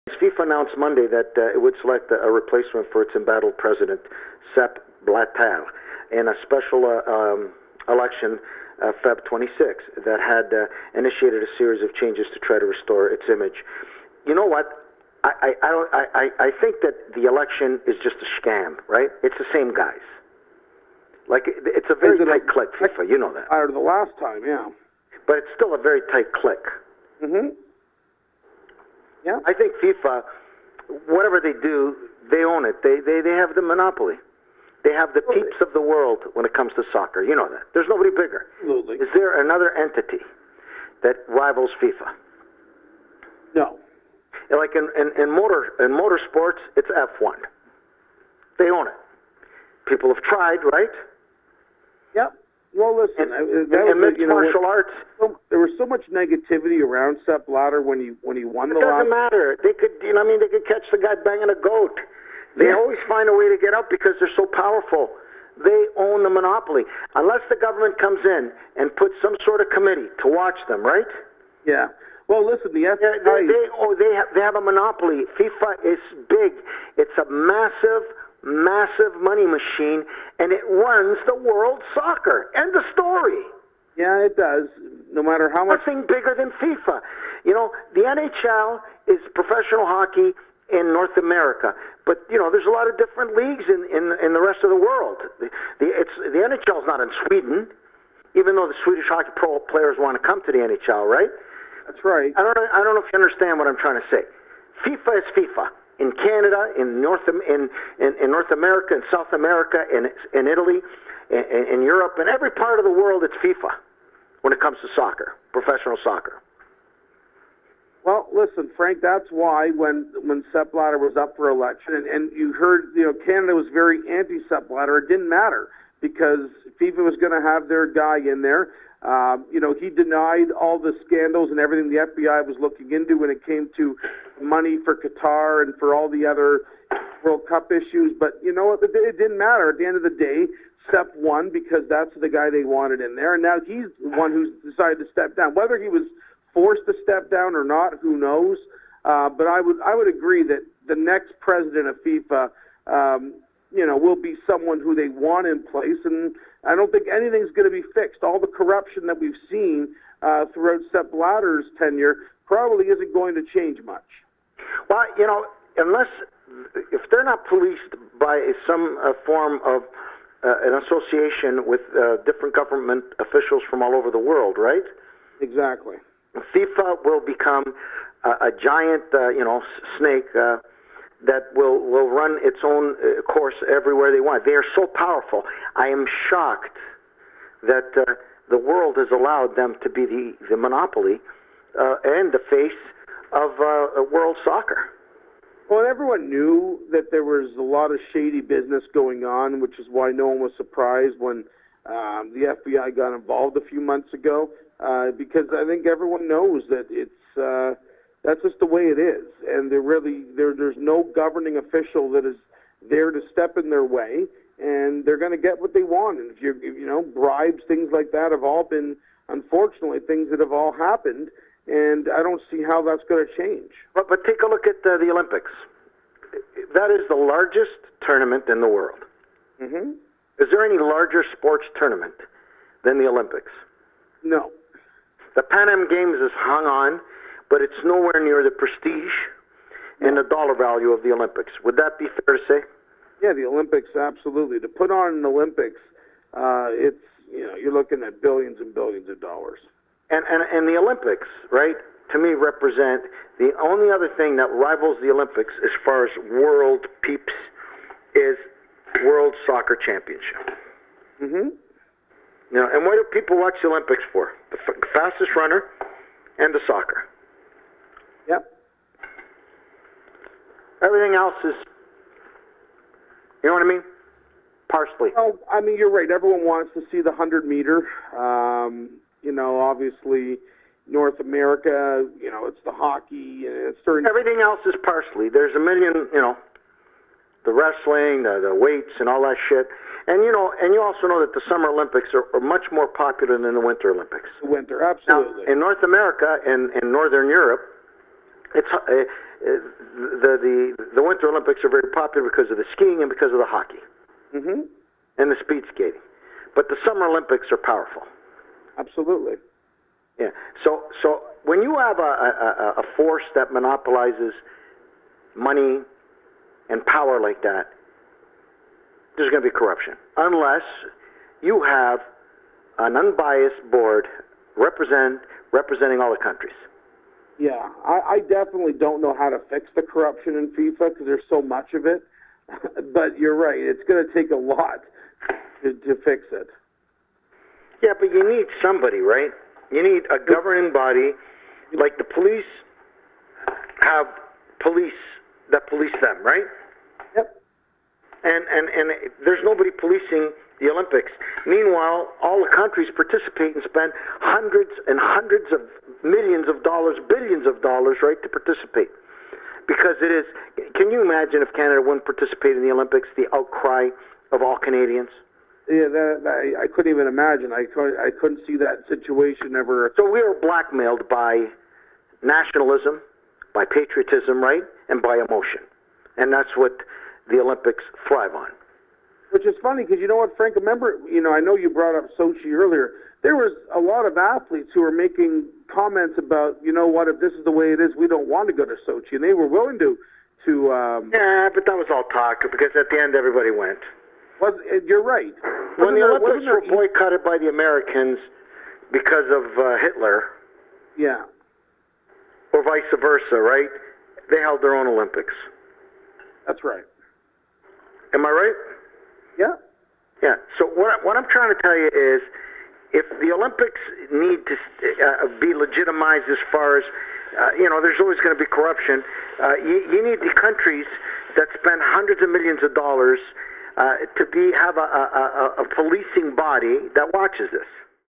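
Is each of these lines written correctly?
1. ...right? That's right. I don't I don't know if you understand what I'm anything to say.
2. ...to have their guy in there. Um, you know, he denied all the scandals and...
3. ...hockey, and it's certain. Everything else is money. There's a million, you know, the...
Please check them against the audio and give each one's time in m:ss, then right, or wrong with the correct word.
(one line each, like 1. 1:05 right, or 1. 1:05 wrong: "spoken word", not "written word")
1. 1:41 wrong: "trying", not "anything"
2. 2:07 right
3. 4:42 wrong: "parsley", not "money".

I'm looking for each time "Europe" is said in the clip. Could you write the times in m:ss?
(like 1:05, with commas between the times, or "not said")
1:51, 4:57.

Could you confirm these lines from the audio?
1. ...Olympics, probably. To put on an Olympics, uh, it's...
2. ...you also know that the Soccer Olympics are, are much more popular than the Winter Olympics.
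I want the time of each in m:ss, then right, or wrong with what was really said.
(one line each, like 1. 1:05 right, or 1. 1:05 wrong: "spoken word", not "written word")
1. 4:03 wrong: "absolutely", not "probably"
2. 4:50 wrong: "Summer", not "Soccer".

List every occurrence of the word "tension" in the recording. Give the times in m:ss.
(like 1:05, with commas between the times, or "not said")
not said.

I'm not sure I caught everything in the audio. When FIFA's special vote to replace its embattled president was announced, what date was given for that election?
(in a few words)
Feb 26.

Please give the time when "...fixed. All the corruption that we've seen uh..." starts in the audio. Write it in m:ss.
2:37.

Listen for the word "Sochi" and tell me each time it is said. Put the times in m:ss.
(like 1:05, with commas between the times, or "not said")
6:22, 6:28.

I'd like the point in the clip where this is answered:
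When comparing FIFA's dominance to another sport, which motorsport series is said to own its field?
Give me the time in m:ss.
0:46.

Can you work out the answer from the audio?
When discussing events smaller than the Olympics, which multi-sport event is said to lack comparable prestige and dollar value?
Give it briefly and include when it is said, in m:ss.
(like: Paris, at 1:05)
Pan Am Games, at 3:55.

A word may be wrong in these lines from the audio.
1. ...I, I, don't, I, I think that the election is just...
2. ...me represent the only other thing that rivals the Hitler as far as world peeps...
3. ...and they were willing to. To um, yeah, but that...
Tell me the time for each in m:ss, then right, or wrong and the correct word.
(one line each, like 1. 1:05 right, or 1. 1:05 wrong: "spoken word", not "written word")
1. 0:15 right
2. 4:12 wrong: "Olympics", not "Hitler"
3. 6:29 right.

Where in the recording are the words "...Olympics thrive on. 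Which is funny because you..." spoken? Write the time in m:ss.
6:17.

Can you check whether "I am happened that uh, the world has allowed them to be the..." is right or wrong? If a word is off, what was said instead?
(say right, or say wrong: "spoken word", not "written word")
wrong: "shocked", not "happened".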